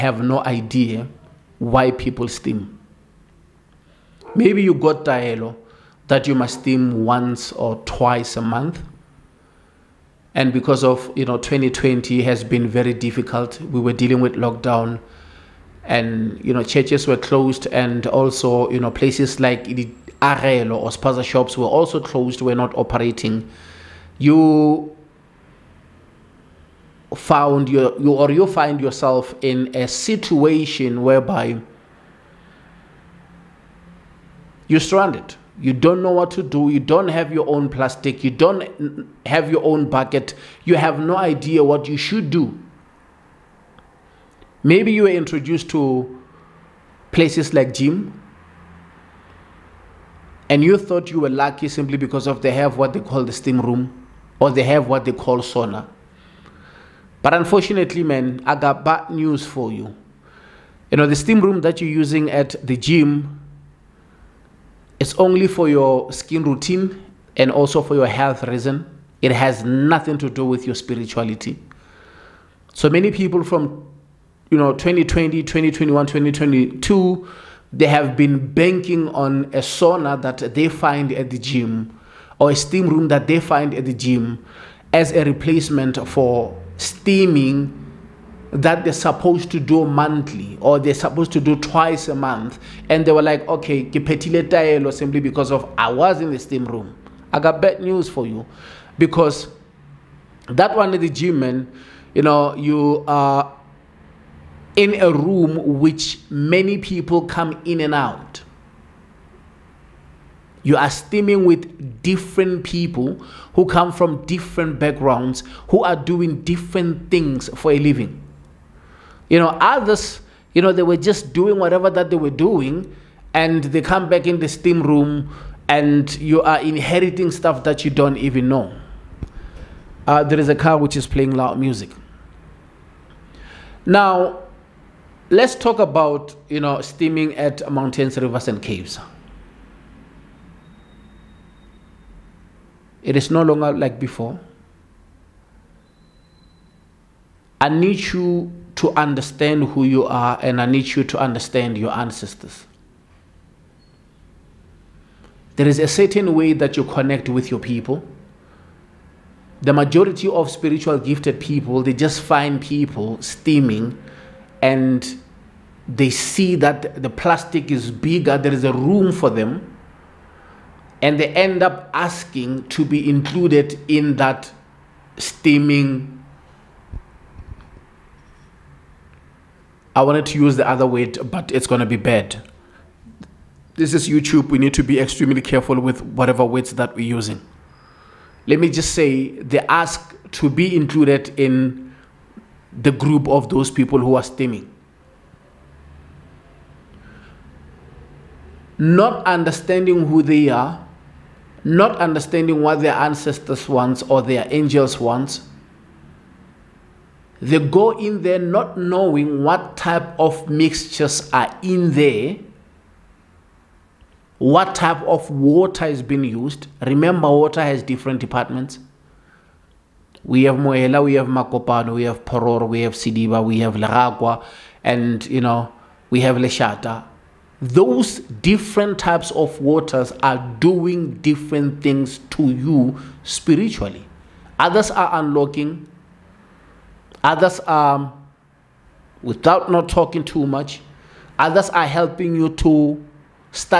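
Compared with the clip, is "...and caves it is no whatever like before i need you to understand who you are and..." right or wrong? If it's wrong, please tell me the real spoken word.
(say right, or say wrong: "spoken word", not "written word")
wrong: "longer", not "whatever".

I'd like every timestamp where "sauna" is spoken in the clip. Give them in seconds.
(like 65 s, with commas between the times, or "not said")
55 s, 79 s.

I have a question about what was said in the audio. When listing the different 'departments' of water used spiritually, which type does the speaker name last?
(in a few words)
Leshata.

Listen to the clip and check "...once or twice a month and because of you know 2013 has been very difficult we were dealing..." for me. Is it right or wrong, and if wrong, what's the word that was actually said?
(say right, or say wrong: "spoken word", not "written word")
wrong: "2020", not "2013".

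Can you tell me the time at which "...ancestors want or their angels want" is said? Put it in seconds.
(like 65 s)
202 s.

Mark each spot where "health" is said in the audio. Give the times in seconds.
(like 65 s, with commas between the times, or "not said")
68 s.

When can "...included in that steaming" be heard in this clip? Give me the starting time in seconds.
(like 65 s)
173 s.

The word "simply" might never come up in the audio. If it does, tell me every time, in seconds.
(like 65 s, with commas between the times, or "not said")
51 s, 94 s.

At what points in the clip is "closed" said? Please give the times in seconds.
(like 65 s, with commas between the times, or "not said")
17 s, 21 s.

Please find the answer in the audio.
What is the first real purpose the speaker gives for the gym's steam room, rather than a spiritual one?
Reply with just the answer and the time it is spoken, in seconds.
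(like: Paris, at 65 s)
Skin routine, at 66 s.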